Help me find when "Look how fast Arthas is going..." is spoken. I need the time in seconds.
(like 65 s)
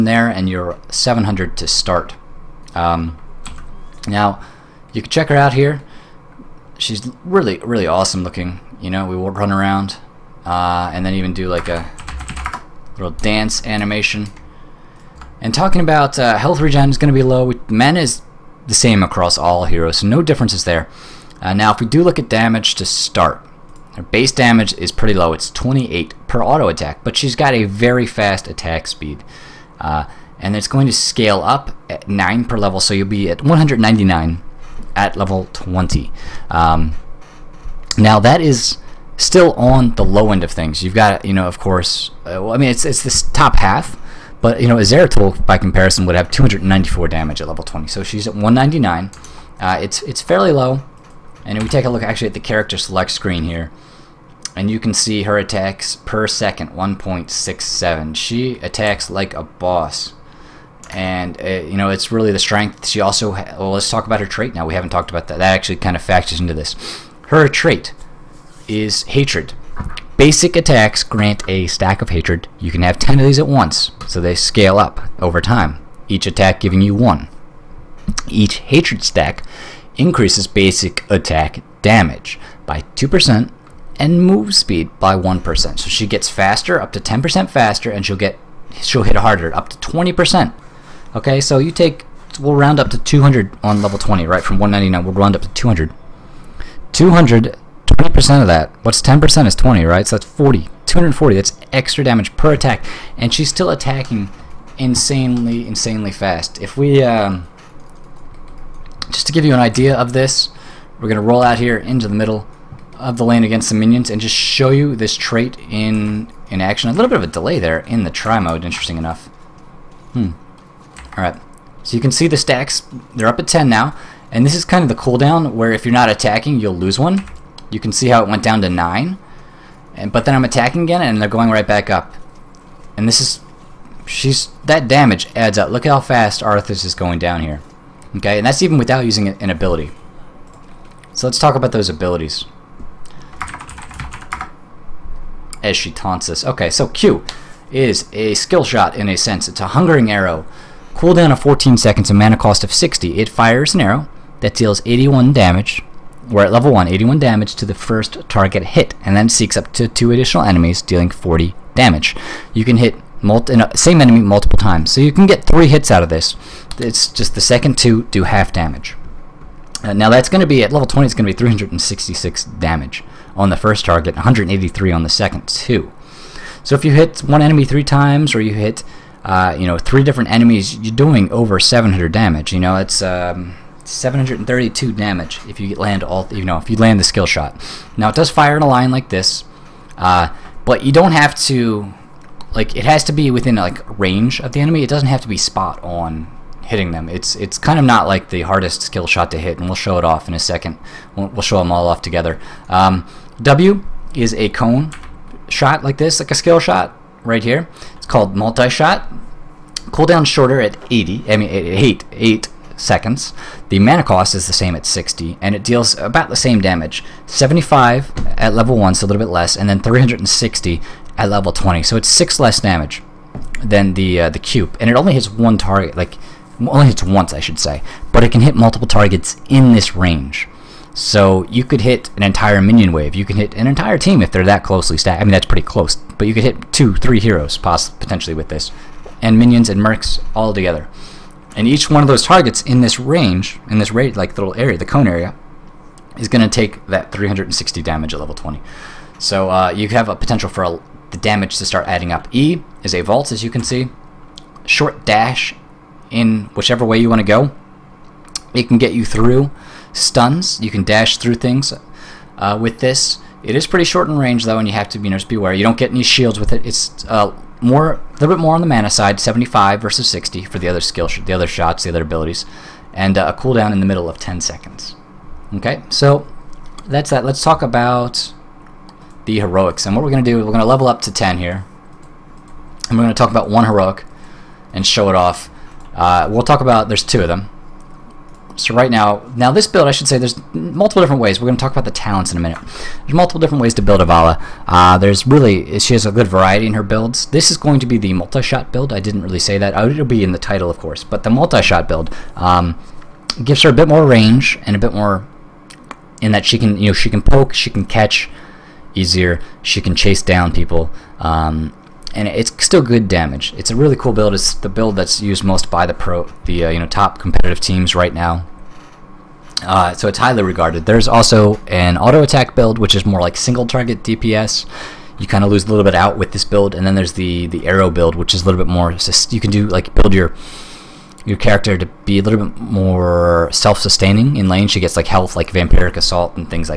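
135 s.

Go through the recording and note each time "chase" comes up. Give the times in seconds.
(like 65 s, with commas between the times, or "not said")
309 s.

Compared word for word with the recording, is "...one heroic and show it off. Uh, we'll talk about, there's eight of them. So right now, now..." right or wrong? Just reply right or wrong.
wrong.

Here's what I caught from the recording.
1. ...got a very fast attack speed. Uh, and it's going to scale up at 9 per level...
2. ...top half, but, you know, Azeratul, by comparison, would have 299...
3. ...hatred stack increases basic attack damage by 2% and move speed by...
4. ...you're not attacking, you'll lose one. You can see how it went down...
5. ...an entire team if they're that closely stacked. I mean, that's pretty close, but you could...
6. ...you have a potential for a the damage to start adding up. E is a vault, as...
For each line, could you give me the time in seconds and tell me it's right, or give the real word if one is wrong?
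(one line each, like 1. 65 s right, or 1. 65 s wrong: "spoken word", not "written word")
1. 27 s right
2. 43 s wrong: "294", not "299"
3. 78 s right
4. 125 s right
5. 233 s right
6. 249 s right.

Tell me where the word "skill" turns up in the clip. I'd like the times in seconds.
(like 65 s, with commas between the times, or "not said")
148 s, 187 s, 198 s, 206 s, 270 s.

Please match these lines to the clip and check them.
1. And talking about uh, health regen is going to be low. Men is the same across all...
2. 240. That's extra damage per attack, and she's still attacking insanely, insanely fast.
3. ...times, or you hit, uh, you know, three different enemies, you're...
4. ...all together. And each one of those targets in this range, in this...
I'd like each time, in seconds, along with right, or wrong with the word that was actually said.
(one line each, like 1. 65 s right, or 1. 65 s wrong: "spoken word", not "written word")
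1. 15 s right
2. 100 s right
3. 177 s right
4. 240 s right.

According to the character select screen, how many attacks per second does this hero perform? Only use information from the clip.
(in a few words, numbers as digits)
1.67.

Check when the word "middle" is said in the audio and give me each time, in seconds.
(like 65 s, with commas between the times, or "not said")
112 s, 273 s.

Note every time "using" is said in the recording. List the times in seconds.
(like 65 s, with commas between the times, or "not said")
139 s.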